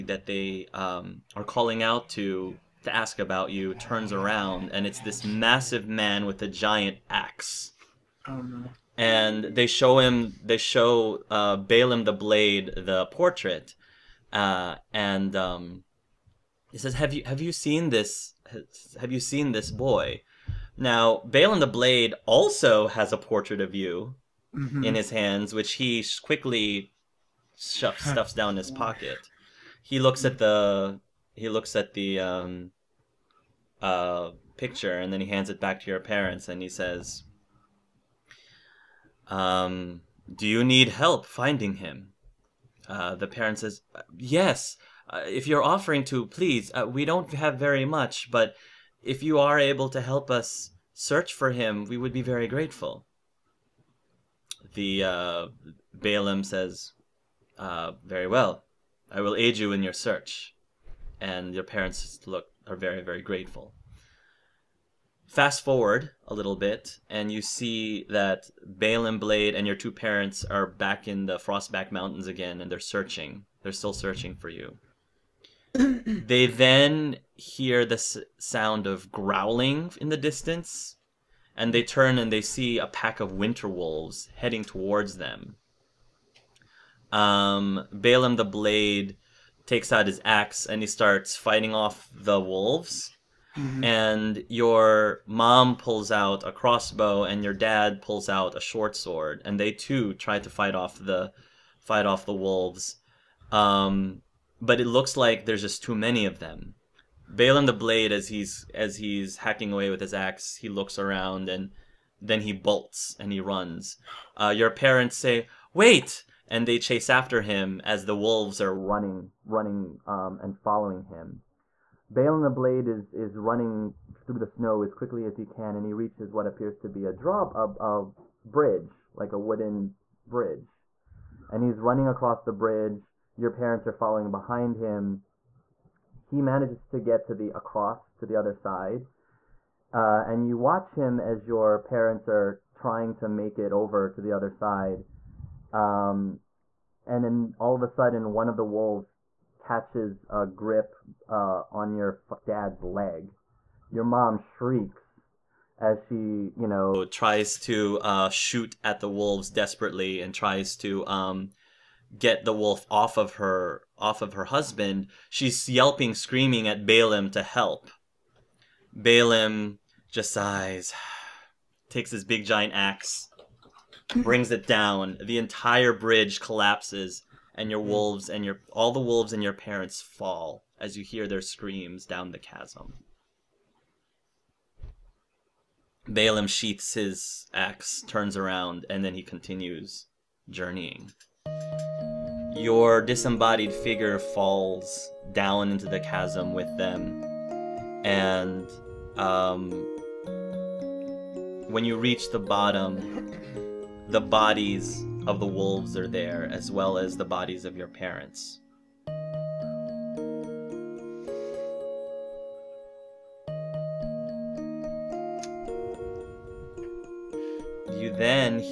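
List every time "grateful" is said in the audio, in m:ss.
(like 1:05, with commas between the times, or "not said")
0:52, 1:03.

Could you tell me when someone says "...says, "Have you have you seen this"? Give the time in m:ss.
0:16.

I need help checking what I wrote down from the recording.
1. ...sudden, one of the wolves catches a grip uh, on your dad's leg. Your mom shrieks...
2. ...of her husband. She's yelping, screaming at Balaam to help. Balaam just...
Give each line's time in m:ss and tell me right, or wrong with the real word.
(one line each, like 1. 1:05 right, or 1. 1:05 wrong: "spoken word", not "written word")
1. 2:27 right
2. 2:44 right.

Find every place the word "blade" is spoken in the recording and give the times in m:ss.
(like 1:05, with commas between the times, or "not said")
0:12, 0:21, 1:09, 1:28, 1:47, 2:02.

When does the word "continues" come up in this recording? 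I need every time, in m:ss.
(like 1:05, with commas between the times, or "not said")
3:09.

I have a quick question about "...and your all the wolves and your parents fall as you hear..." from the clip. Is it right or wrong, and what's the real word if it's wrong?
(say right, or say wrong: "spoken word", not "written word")
right.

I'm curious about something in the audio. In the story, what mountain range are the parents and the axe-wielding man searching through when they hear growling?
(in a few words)
Frostback Mountains.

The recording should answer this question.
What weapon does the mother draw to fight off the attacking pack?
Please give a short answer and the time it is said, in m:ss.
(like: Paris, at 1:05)
Crossbow, at 1:36.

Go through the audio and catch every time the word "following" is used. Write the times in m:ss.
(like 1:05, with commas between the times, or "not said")
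2:00, 2:13.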